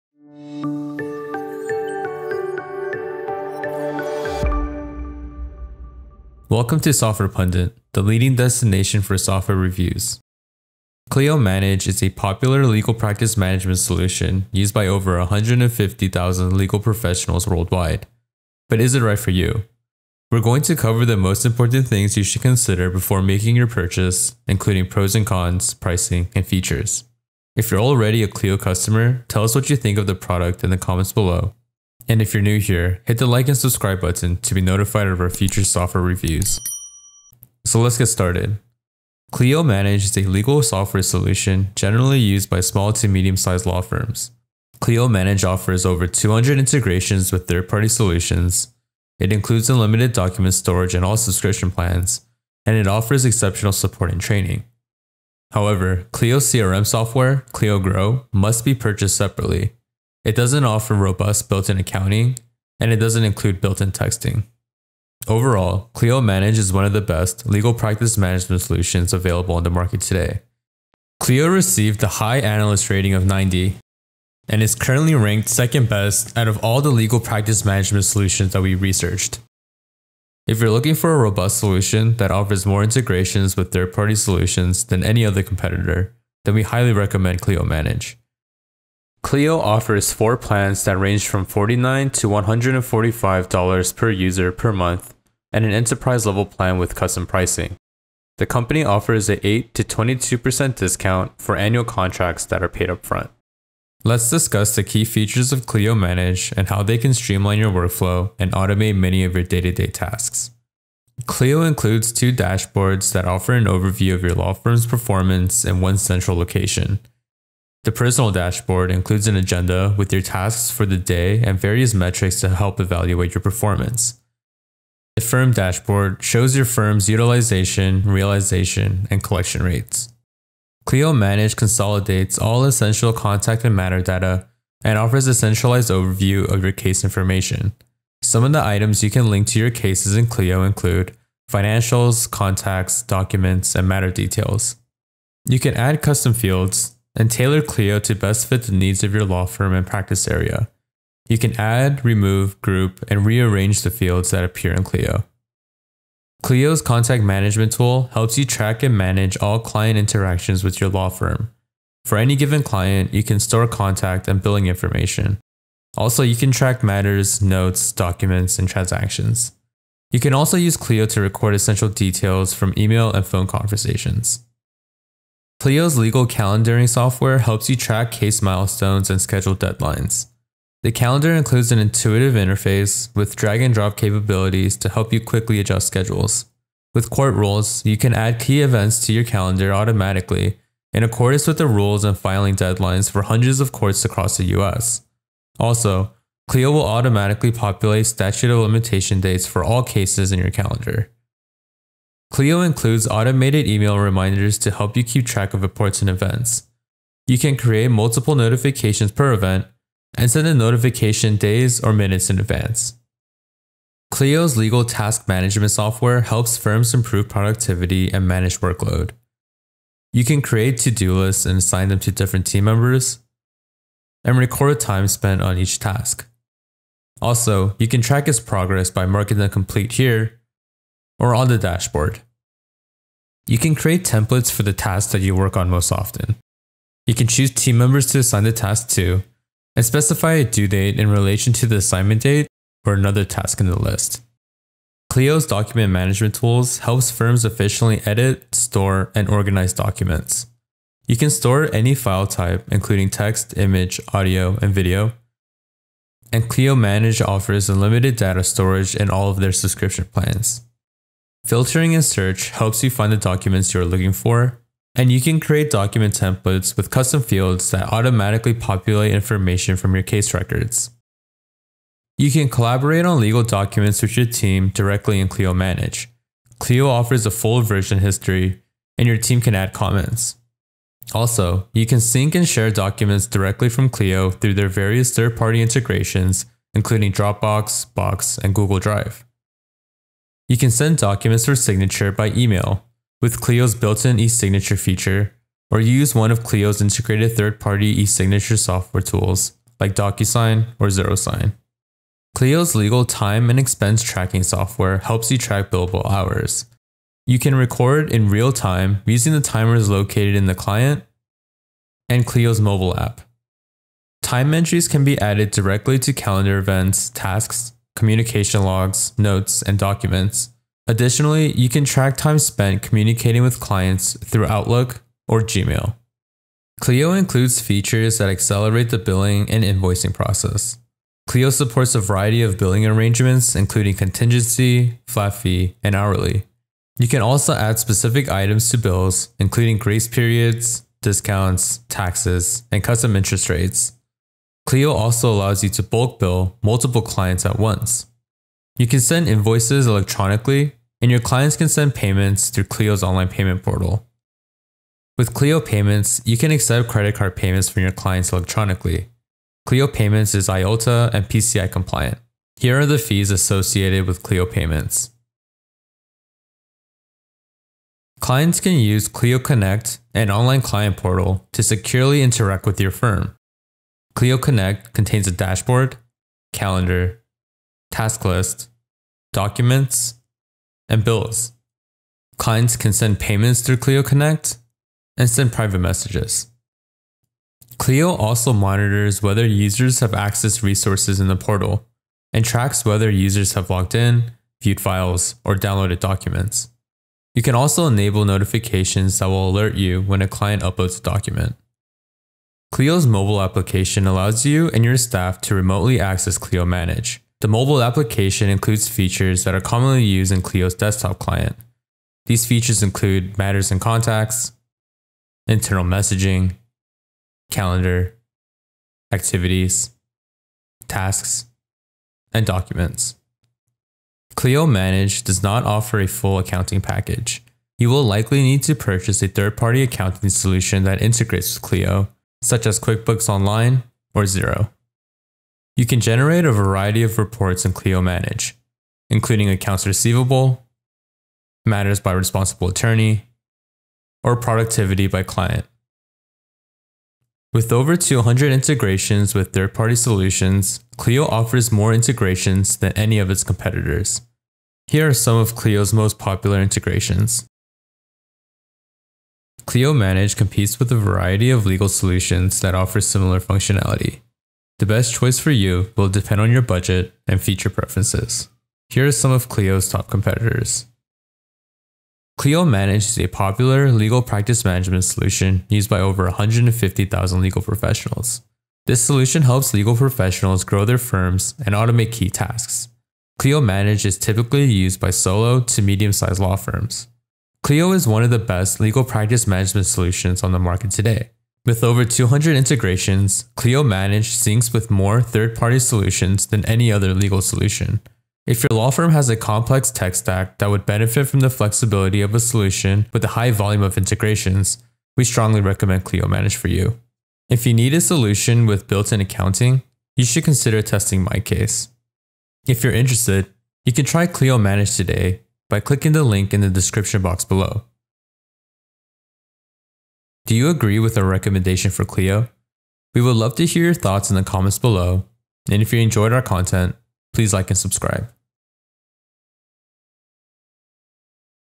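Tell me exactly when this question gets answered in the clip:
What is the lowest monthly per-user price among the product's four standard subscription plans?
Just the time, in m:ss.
1:31.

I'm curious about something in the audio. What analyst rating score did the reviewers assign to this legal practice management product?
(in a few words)
90.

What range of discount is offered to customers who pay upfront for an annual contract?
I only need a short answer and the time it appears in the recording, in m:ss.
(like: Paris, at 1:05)
8 to 22%, at 1:39.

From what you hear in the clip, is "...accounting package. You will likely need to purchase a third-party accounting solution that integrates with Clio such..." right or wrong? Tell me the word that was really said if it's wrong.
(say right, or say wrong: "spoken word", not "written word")
right.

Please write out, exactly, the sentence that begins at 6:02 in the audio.
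Here are the fees associated with Clio Payments.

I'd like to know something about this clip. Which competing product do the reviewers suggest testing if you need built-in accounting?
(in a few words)
MyCase.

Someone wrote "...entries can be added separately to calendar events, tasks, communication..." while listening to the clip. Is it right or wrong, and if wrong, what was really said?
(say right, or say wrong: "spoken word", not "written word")
wrong: "directly", not "separately".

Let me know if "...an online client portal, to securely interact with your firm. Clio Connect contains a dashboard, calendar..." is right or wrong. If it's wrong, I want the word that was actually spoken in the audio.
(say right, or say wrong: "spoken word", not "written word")
right.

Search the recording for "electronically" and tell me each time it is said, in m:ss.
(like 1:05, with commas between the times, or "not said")
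5:49, 5:58.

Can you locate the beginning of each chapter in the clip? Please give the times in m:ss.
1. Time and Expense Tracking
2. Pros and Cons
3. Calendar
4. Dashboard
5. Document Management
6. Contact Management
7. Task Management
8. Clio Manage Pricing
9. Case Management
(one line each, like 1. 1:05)
1. 5:01
2. 0:44
3. 2:54
4. 1:50
5. 4:04
6. 2:35
7. 3:34
8. 1:28
9. 2:10.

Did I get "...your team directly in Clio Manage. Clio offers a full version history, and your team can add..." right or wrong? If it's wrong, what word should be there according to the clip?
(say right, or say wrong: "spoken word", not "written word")
right.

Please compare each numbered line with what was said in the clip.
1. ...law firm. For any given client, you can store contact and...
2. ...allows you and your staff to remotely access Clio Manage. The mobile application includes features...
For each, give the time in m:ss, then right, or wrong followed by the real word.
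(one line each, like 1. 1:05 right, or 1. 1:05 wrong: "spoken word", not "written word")
1. 2:40 right
2. 6:44 right.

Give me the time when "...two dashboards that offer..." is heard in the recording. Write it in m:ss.
1:52.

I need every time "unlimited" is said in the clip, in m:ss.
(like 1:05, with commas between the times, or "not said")
0:49, 4:17.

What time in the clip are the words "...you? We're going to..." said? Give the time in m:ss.
0:19.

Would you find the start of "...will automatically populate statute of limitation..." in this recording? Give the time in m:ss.
3:16.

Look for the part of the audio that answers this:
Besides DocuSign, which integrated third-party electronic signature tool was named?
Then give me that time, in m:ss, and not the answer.
5:00.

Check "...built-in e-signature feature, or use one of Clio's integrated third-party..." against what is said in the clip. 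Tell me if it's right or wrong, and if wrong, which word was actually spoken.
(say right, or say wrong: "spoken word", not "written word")
right.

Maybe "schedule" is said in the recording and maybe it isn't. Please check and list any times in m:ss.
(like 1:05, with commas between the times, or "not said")
2:59, 3:05.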